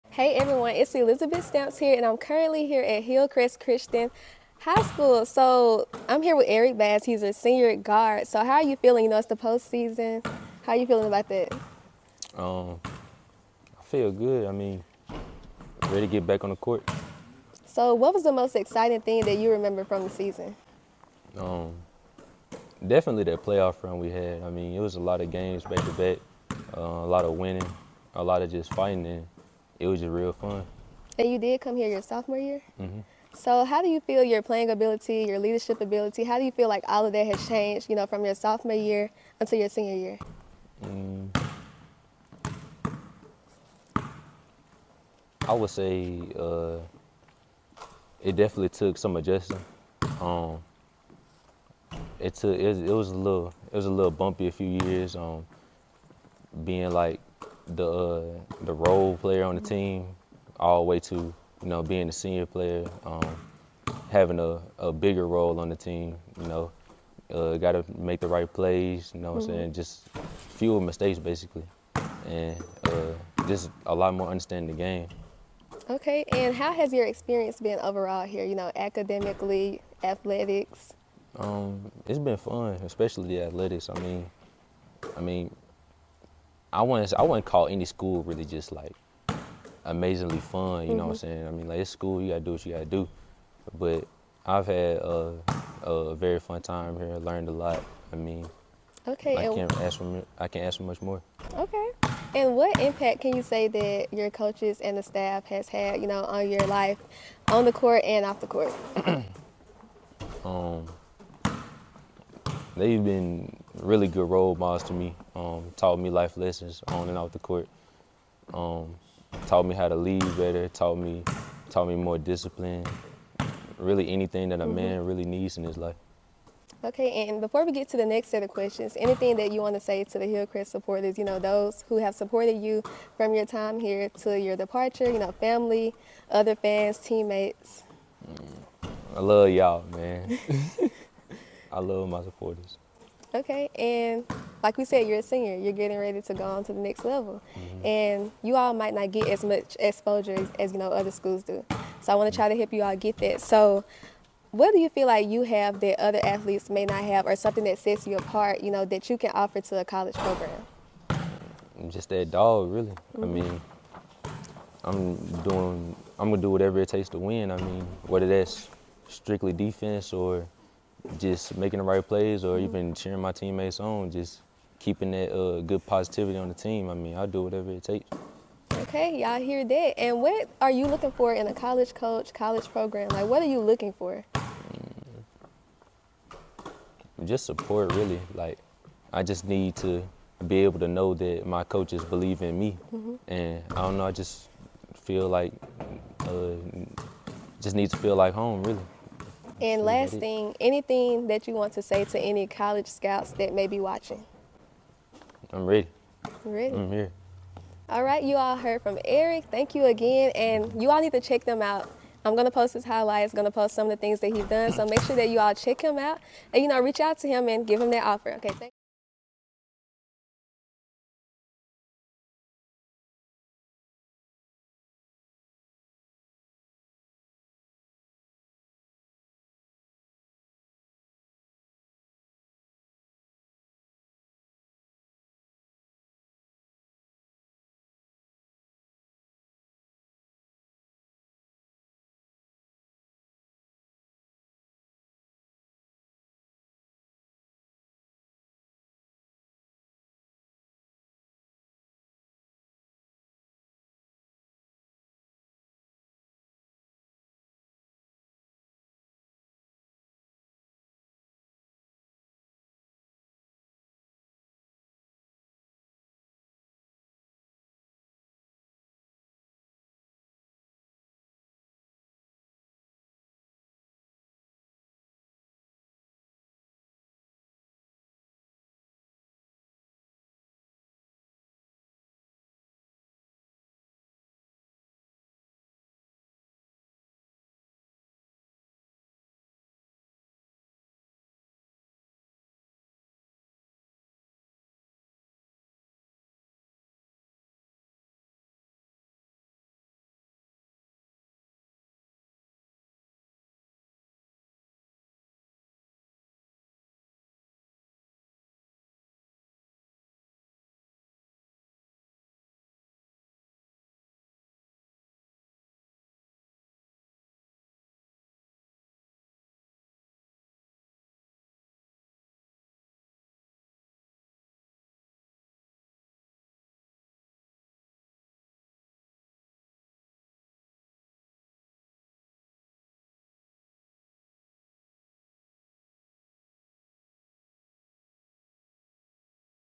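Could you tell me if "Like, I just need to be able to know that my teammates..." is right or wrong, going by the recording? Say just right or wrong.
wrong.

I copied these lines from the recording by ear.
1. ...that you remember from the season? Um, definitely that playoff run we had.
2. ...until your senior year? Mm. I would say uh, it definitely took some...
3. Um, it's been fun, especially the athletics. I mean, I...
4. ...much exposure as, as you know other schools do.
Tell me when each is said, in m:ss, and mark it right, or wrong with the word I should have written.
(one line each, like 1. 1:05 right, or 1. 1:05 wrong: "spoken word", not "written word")
1. 0:19 right
2. 0:39 right
3. 1:21 right
4. 2:29 right.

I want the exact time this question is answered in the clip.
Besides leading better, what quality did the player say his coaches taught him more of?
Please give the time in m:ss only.
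2:02.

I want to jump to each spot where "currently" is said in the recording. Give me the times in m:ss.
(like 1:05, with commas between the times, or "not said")
0:02.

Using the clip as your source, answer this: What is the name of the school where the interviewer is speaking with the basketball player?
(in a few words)
Hillcrest Christian High School.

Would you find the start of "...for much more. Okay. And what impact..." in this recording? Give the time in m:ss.
1:40.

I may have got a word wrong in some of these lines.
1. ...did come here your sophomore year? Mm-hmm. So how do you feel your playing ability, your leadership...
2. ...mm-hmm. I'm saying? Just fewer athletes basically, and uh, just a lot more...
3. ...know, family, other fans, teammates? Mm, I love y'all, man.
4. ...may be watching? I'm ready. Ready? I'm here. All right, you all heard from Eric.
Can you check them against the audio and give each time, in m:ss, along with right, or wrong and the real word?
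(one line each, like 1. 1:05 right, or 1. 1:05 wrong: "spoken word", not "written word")
1. 0:31 right
2. 1:09 wrong: "mistakes", not "athletes"
3. 2:15 right
4. 3:23 right.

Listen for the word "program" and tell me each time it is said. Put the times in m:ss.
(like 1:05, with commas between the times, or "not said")
2:40, 3:02.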